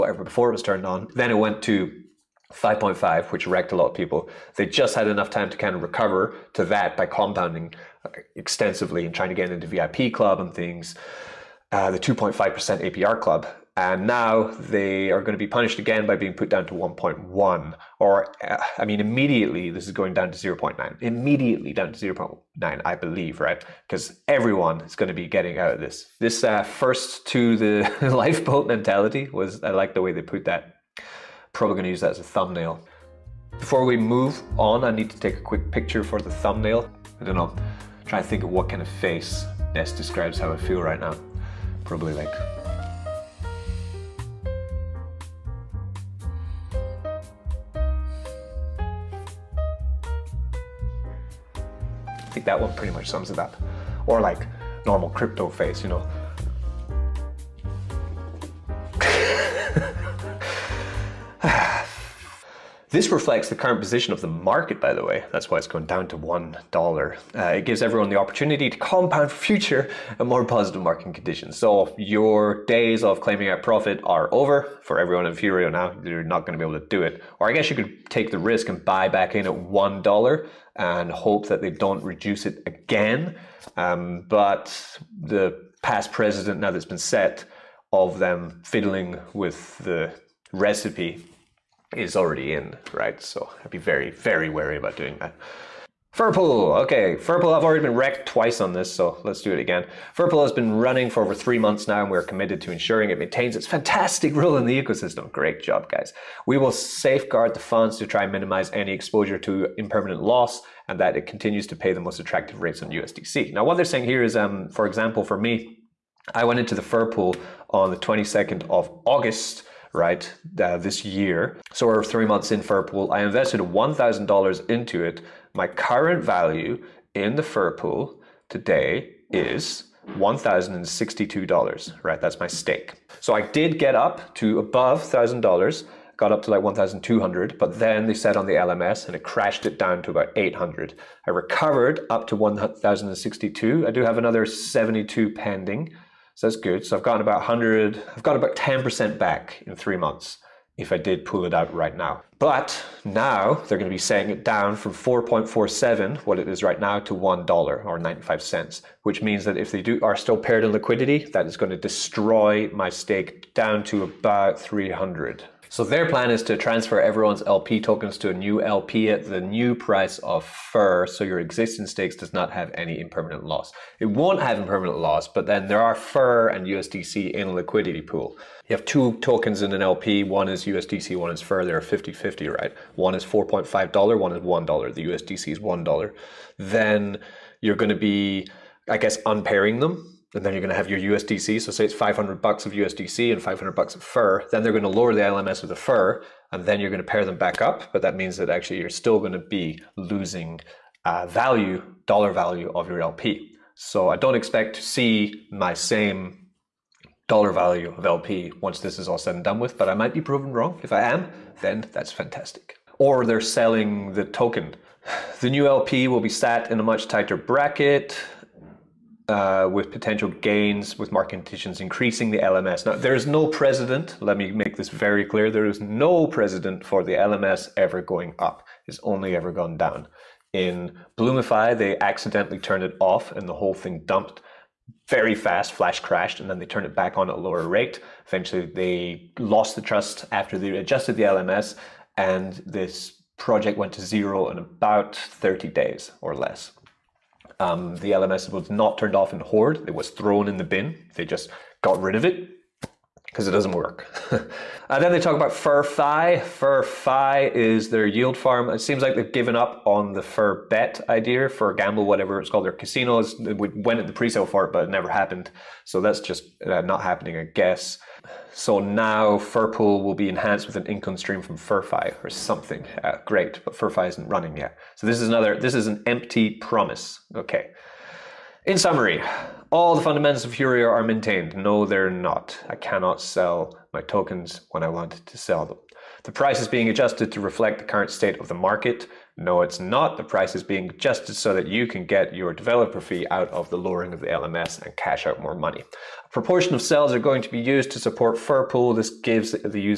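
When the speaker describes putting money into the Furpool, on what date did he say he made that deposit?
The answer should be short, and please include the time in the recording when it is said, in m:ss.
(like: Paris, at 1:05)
22nd of August, at 1:57.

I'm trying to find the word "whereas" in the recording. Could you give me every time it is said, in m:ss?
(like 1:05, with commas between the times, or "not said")
not said.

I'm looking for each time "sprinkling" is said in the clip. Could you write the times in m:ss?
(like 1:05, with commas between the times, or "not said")
not said.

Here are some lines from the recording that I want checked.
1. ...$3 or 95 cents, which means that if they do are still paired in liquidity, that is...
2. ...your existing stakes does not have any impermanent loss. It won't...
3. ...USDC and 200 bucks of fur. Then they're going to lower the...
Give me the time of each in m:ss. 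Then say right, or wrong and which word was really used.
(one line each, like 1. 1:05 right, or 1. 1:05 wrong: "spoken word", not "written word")
1. 2:37 wrong: "1", not "3"
2. 2:51 right
3. 3:12 wrong: "500", not "200".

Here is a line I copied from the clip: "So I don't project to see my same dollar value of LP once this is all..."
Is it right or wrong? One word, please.
wrong.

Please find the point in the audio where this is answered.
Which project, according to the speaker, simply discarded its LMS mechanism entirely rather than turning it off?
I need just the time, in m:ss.
4:09.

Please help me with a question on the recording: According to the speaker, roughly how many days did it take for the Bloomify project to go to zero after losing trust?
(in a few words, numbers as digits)
30.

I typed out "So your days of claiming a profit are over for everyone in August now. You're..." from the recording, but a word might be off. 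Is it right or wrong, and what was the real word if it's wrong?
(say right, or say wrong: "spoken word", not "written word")
wrong: "Furio", not "August".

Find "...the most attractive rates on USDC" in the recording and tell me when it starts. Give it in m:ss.
1:51.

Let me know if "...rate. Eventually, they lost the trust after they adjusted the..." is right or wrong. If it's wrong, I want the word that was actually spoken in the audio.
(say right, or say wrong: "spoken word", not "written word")
right.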